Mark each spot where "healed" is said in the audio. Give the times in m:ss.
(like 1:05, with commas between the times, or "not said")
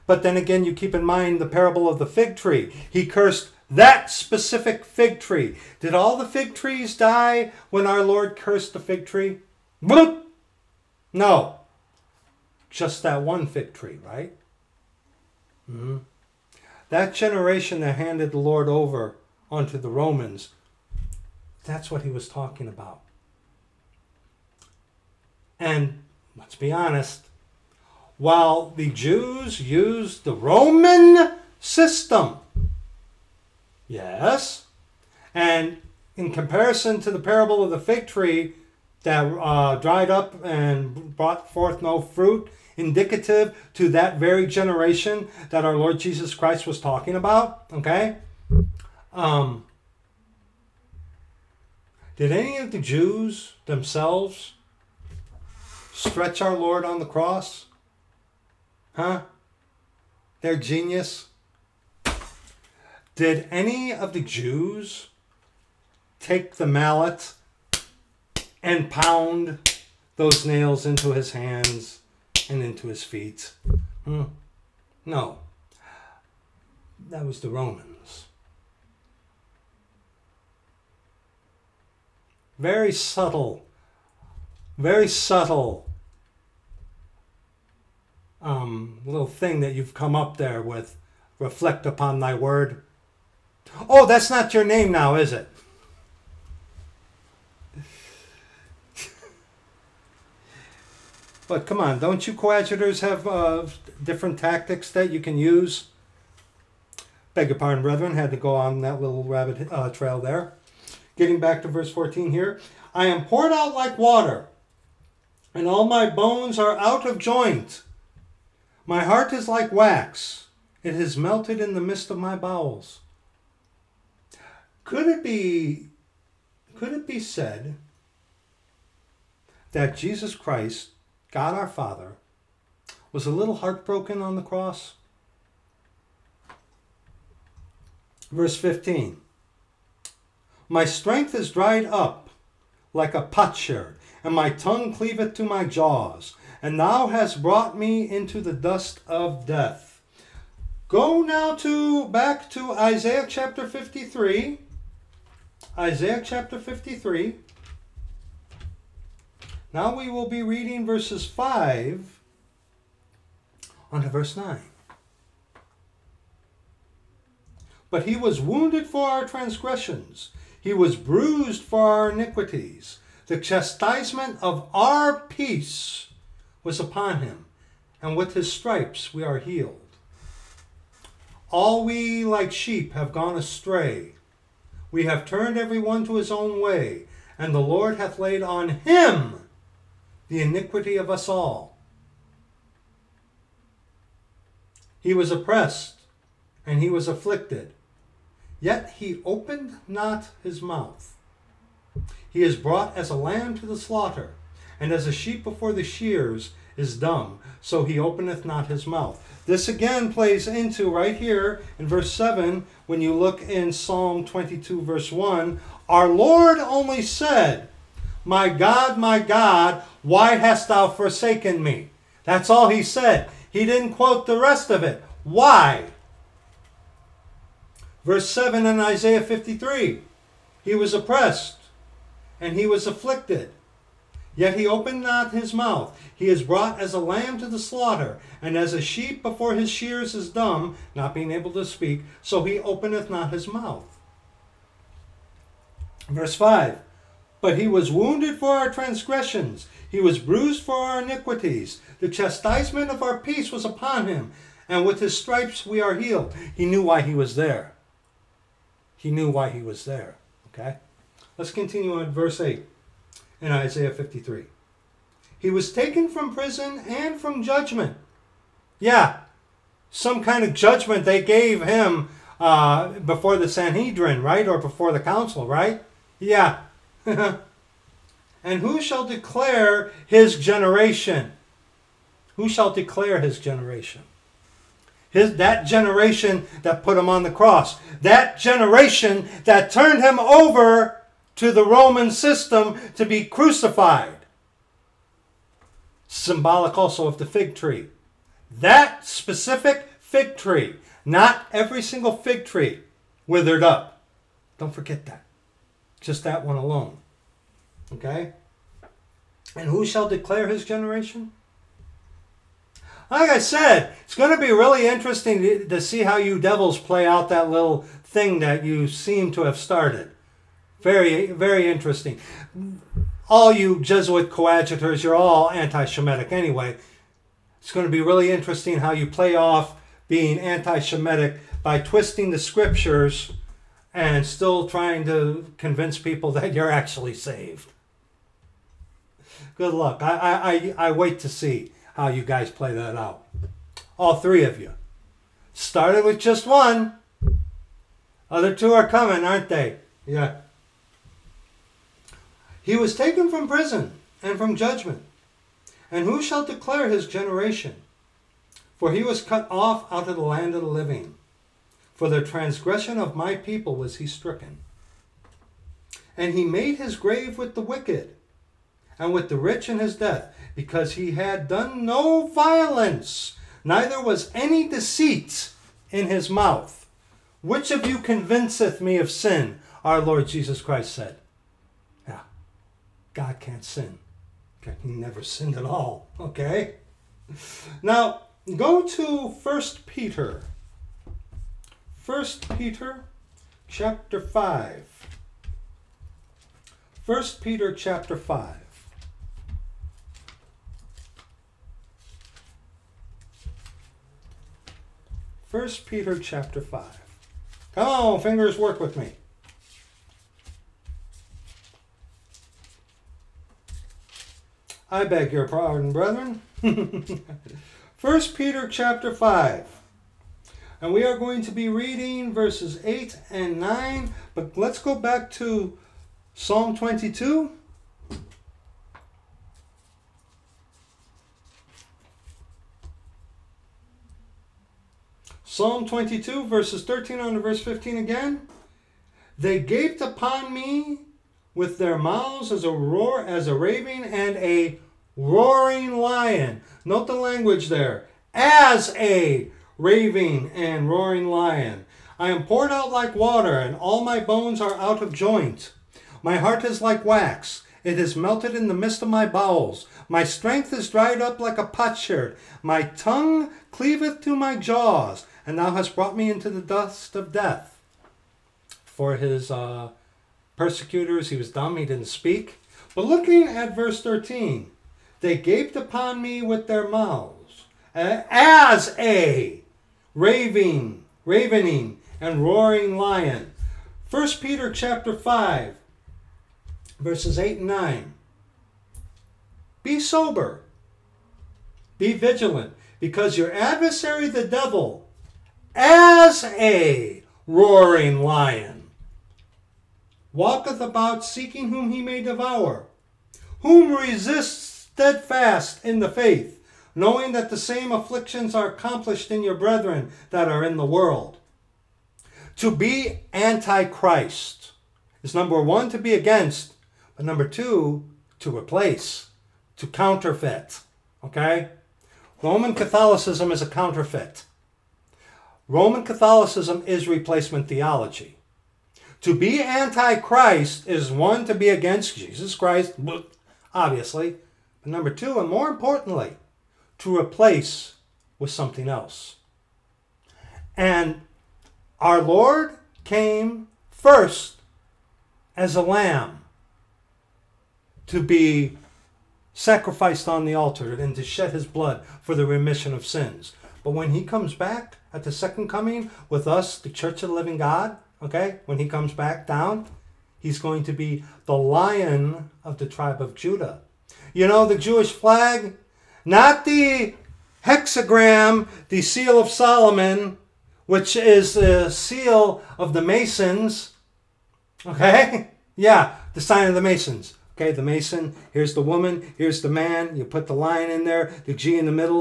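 2:59, 4:15.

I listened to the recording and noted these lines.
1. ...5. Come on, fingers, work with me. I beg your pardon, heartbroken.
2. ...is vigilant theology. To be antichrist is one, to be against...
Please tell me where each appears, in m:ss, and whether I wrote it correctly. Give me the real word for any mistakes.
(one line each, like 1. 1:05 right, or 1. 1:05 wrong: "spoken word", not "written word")
1. 6:46 wrong: "brethren", not "heartbroken"
2. 8:46 wrong: "replacement", not "vigilant".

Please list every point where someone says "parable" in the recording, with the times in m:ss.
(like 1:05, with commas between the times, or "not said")
0:01, 0:37.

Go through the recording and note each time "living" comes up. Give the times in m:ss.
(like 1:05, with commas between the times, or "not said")
6:00, 9:17.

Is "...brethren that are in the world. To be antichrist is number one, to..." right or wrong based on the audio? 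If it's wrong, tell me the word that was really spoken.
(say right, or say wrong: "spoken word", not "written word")
right.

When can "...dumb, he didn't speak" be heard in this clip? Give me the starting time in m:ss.
7:51.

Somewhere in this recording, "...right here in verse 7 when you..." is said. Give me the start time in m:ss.
3:30.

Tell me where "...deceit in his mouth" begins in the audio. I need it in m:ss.
6:14.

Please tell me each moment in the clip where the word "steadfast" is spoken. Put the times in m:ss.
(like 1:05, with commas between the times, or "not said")
8:24.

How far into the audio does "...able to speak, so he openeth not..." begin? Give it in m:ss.
4:01.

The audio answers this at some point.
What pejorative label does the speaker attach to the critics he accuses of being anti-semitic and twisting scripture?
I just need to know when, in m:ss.
5:23.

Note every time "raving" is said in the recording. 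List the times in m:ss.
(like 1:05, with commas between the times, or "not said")
7:23, 7:29, 8:00.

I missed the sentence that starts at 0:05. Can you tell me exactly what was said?
Did all the fig trees die when our Lord cursed the fig tree?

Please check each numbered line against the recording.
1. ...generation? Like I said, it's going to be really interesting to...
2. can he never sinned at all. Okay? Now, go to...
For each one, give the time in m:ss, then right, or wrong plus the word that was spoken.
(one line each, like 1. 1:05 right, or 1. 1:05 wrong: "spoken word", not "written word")
1. 5:10 right
2. 6:24 right.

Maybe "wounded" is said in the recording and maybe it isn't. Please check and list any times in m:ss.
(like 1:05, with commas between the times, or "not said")
2:48, 4:07.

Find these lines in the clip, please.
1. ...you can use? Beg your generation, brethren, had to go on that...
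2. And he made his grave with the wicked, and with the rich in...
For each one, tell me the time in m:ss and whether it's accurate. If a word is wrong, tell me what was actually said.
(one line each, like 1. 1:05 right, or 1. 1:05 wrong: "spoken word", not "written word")
1. 1:45 wrong: "pardon", not "generation"
2. 6:06 right.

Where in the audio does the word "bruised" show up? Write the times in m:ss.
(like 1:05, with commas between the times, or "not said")
2:50, 4:10.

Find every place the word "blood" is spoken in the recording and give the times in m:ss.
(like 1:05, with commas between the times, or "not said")
9:11.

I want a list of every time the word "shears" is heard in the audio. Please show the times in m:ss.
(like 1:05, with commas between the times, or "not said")
3:25, 3:59.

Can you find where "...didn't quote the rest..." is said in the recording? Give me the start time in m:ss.
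3:43.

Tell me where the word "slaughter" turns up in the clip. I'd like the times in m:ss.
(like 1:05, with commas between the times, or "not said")
3:23, 3:57.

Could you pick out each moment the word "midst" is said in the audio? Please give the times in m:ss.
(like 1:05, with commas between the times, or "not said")
2:01, 7:38.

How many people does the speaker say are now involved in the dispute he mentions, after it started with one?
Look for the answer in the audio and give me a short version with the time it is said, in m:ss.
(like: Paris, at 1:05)
3, at 5:44.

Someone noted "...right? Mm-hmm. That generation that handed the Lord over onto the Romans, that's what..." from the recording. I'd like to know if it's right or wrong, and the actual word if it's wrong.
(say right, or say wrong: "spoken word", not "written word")
right.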